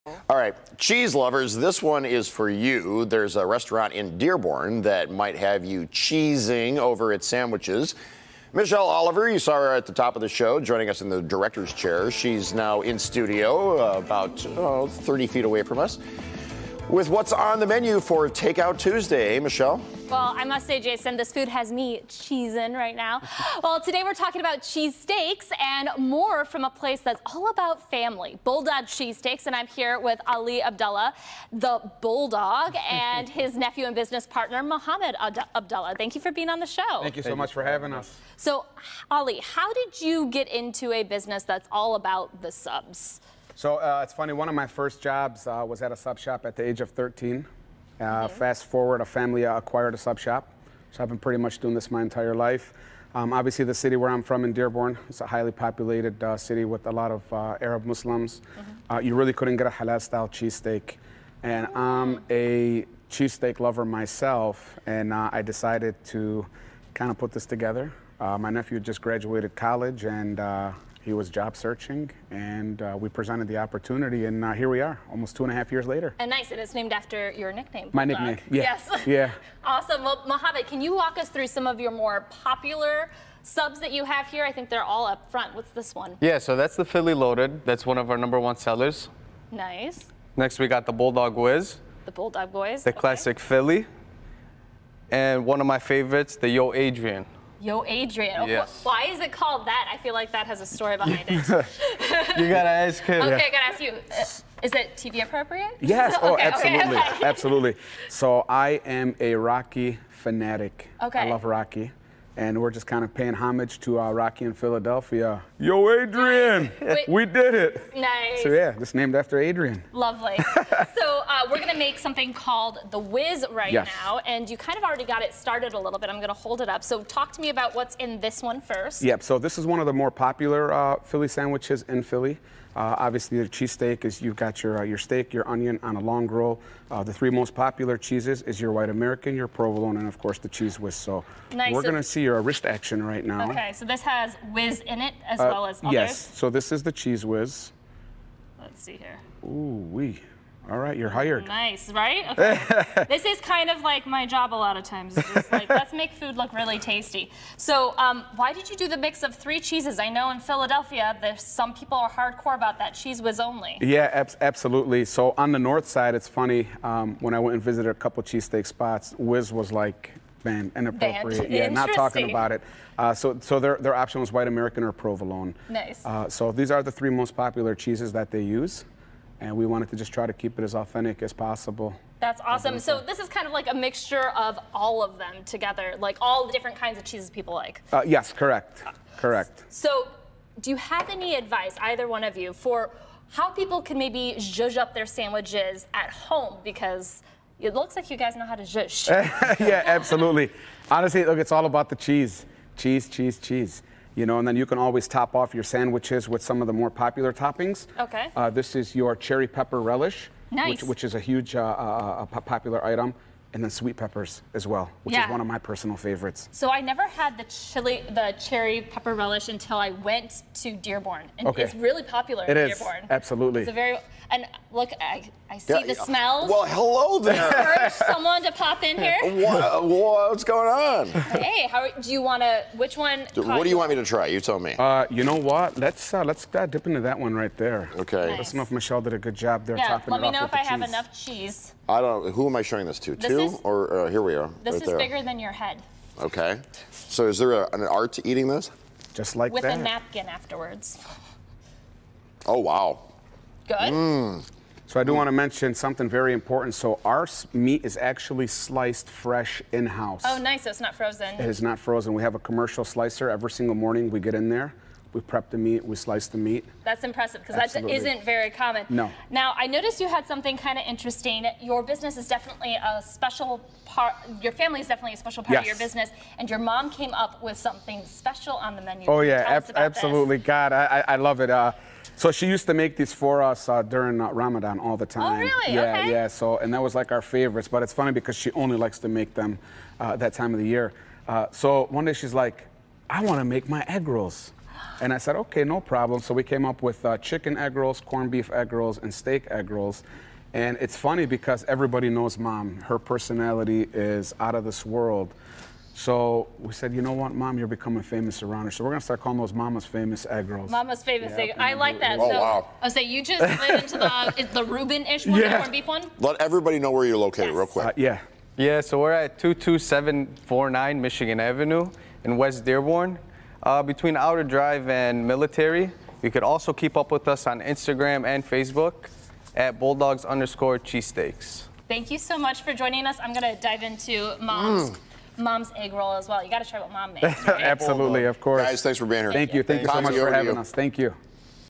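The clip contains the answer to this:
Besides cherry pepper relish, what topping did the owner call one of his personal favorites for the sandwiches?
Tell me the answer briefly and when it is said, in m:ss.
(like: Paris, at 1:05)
sweet peppers, at 3:33.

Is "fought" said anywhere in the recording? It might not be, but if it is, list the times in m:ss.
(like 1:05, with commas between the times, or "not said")
not said.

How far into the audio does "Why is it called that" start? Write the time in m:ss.
1:38.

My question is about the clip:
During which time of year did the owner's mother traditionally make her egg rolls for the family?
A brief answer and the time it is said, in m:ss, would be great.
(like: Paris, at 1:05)
Ramadan, at 4:44.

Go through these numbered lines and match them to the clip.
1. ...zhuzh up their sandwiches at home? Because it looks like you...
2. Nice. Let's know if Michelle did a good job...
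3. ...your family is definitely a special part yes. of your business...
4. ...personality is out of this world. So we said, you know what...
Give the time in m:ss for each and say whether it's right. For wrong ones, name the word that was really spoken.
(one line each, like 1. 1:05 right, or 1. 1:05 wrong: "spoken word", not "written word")
1. 3:14 right
2. 3:58 right
3. 4:34 right
4. 5:02 right.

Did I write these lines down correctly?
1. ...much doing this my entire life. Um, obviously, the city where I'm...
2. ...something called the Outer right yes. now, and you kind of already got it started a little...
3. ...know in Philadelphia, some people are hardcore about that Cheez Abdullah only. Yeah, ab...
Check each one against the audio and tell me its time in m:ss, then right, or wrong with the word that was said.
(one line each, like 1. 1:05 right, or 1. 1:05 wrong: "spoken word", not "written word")
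1. 0:51 right
2. 2:01 wrong: "Whiz", not "Outer"
3. 2:40 wrong: "Whiz", not "Abdullah".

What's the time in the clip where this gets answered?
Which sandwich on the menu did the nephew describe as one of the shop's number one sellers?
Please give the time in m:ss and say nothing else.
1:26.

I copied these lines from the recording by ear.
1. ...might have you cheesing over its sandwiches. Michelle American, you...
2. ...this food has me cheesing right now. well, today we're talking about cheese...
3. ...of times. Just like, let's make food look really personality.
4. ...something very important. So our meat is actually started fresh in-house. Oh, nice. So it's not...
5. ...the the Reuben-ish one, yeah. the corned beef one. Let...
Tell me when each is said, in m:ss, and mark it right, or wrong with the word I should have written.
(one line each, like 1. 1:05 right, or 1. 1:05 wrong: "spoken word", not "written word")
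1. 0:05 wrong: "Oliver", not "American"
2. 0:21 right
3. 2:34 wrong: "tasty", not "personality"
4. 4:15 wrong: "sliced", not "started"
5. 5:13 right.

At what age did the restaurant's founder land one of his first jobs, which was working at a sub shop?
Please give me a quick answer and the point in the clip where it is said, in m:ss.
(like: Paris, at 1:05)
13, at 0:46.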